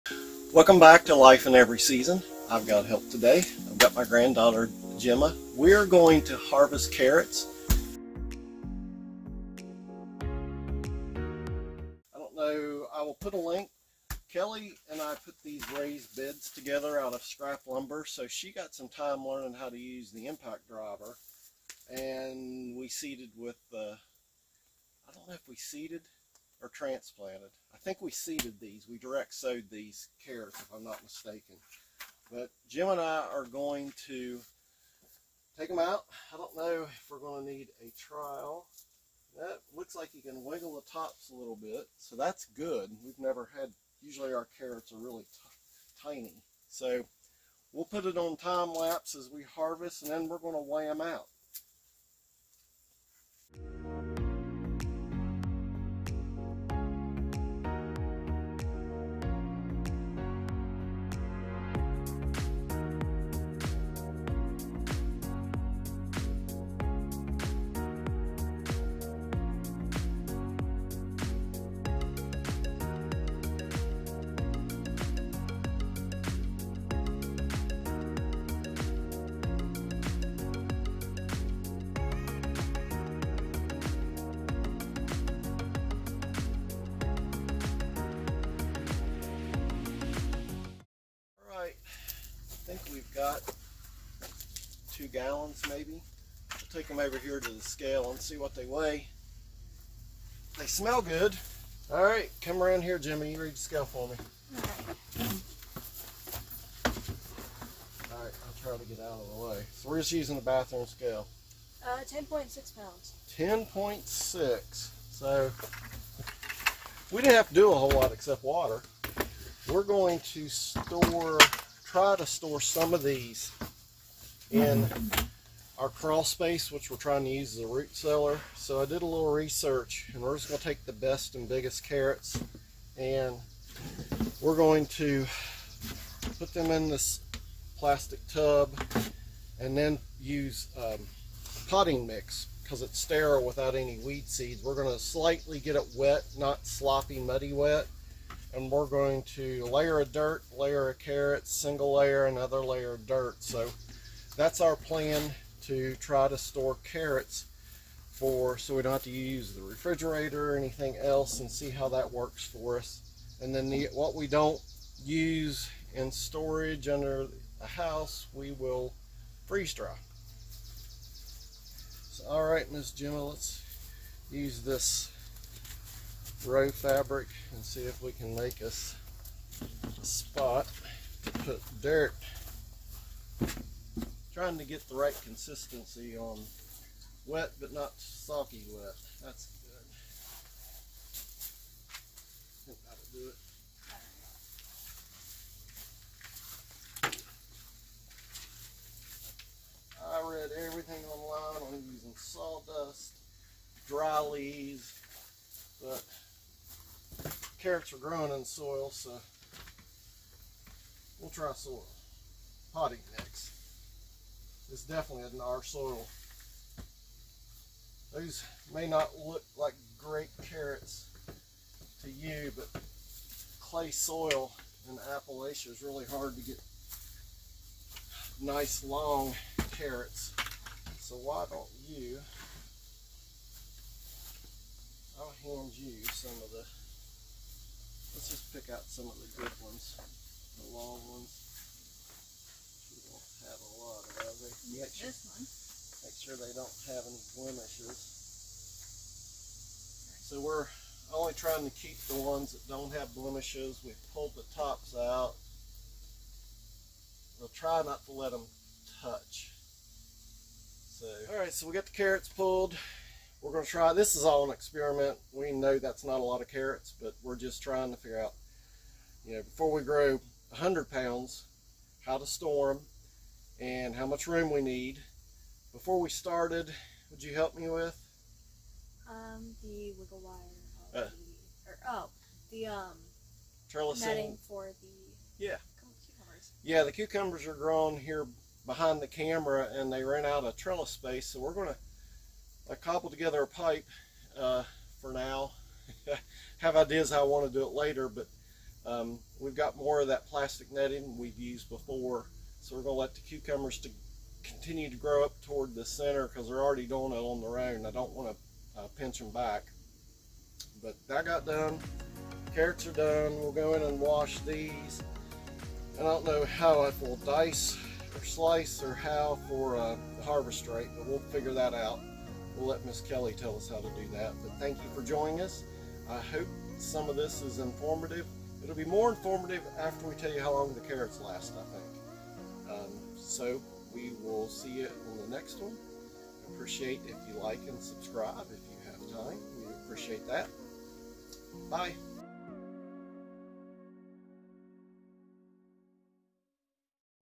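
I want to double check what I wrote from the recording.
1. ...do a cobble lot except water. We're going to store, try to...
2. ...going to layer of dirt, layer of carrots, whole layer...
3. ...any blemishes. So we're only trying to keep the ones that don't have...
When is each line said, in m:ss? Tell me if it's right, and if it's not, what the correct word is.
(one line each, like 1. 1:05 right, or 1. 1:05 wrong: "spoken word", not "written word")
1. 1:57 wrong: "whole", not "cobble"
2. 2:28 wrong: "single", not "whole"
3. 4:07 right.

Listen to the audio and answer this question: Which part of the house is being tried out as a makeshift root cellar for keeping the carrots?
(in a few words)
crawl space.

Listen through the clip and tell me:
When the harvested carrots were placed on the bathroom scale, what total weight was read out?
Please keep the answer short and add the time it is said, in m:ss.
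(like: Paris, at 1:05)
10.6 pounds, at 1:51.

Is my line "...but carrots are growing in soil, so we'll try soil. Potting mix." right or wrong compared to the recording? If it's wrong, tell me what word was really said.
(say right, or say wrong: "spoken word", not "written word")
right.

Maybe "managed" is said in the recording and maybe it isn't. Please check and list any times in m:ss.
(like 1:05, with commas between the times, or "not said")
not said.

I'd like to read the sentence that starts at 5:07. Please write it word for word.
I don't want to uh, pinch them back.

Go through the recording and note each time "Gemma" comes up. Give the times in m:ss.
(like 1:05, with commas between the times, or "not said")
0:04, 0:32, 2:52.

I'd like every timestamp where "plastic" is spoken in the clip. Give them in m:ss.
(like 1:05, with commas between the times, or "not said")
2:17, 5:00.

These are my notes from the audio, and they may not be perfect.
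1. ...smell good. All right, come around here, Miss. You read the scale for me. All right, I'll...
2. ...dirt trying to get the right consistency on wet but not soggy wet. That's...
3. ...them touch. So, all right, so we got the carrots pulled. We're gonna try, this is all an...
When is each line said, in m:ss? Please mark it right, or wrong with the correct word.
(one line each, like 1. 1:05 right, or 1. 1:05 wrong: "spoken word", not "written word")
1. 1:40 wrong: "Jimmy", not "Miss"
2. 3:01 right
3. 4:18 right.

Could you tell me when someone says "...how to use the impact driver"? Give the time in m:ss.
0:19.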